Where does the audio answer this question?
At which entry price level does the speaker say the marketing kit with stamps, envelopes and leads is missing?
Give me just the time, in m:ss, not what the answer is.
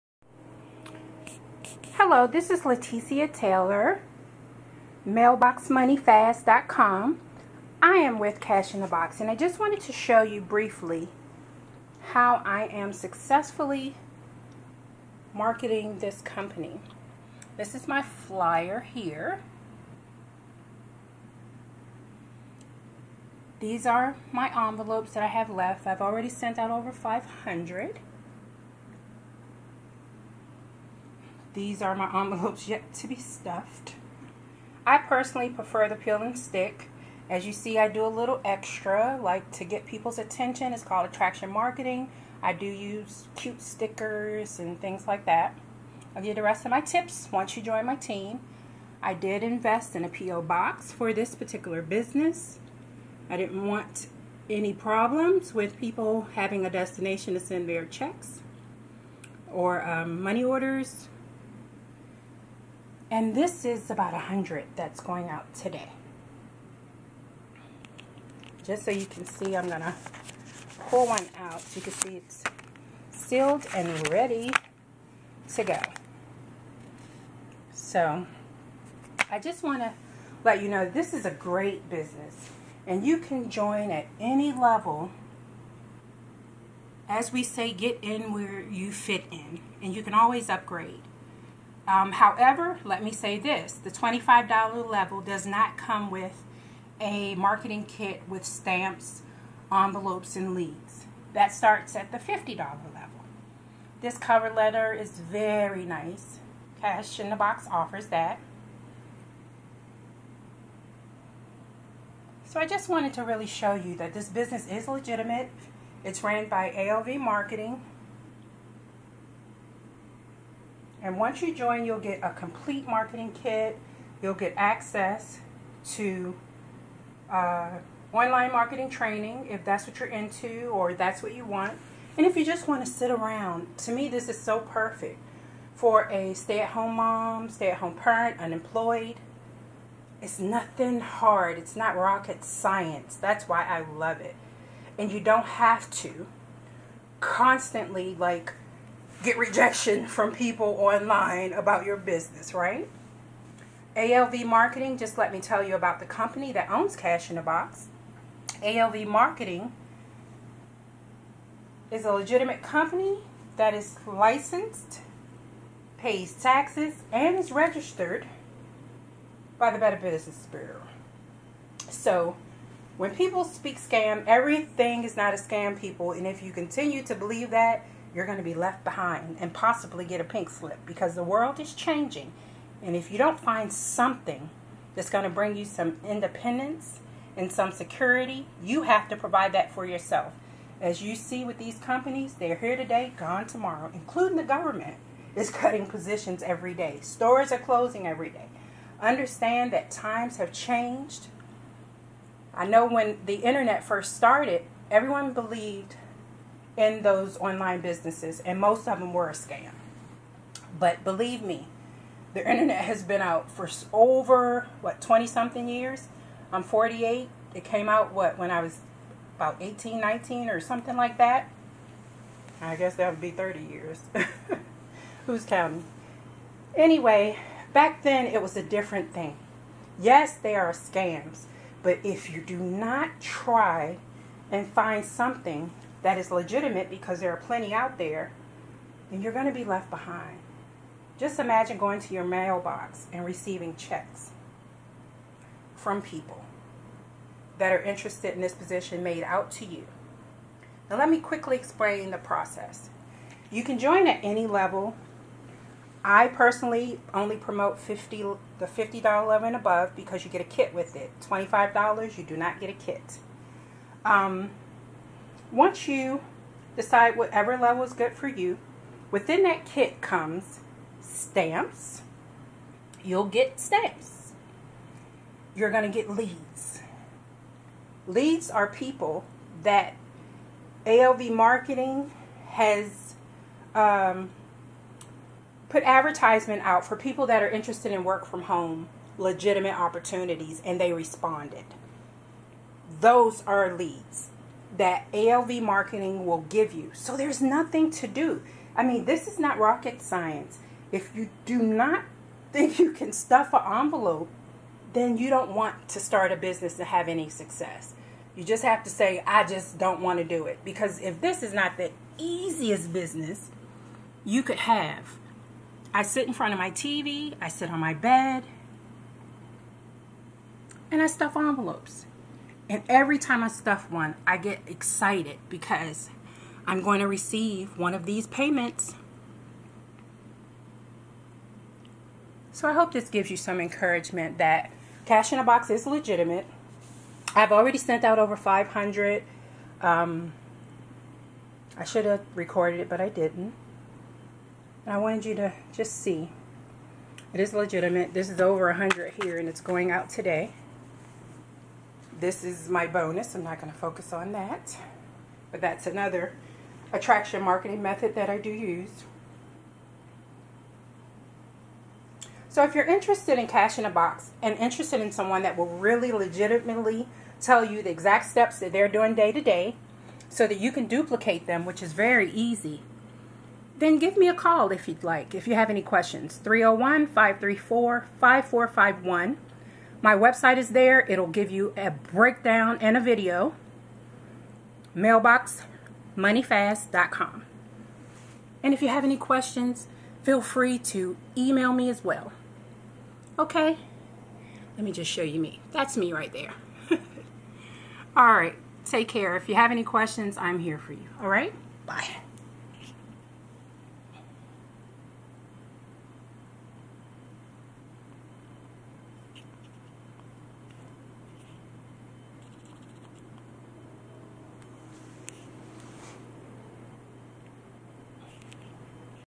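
1:33.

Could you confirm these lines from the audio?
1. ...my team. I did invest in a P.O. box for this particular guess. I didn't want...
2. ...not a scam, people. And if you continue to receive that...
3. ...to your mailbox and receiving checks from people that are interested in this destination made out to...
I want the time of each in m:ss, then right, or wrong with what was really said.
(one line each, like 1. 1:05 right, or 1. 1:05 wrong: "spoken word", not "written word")
1. 0:47 wrong: "business", not "guess"
2. 2:55 wrong: "believe", not "receive"
3. 4:02 wrong: "position", not "destination".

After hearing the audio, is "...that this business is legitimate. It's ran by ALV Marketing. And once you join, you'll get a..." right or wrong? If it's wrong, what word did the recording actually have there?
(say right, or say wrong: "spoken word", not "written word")
right.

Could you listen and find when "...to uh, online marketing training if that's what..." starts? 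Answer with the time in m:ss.
2:05.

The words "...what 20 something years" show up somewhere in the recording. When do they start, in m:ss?
3:34.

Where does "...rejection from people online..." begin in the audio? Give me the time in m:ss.
2:29.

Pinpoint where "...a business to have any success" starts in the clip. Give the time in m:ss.
5:06.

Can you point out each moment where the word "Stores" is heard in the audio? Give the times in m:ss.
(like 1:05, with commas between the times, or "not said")
3:17.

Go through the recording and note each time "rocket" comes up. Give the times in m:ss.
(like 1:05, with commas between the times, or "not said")
2:21, 4:59.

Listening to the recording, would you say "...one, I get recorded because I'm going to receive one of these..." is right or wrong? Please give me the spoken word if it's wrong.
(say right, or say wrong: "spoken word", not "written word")
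wrong: "excited", not "recorded".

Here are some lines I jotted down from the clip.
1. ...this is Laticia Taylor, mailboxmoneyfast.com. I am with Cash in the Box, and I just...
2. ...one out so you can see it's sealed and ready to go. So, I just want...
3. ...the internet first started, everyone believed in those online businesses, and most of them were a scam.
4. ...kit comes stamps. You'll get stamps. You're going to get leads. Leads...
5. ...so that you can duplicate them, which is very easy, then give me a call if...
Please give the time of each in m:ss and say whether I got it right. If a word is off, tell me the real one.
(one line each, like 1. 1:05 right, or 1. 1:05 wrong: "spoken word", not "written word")
1. 0:02 right
2. 1:11 right
3. 3:23 right
4. 4:29 right
5. 6:10 right.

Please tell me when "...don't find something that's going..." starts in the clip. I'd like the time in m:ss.
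3:03.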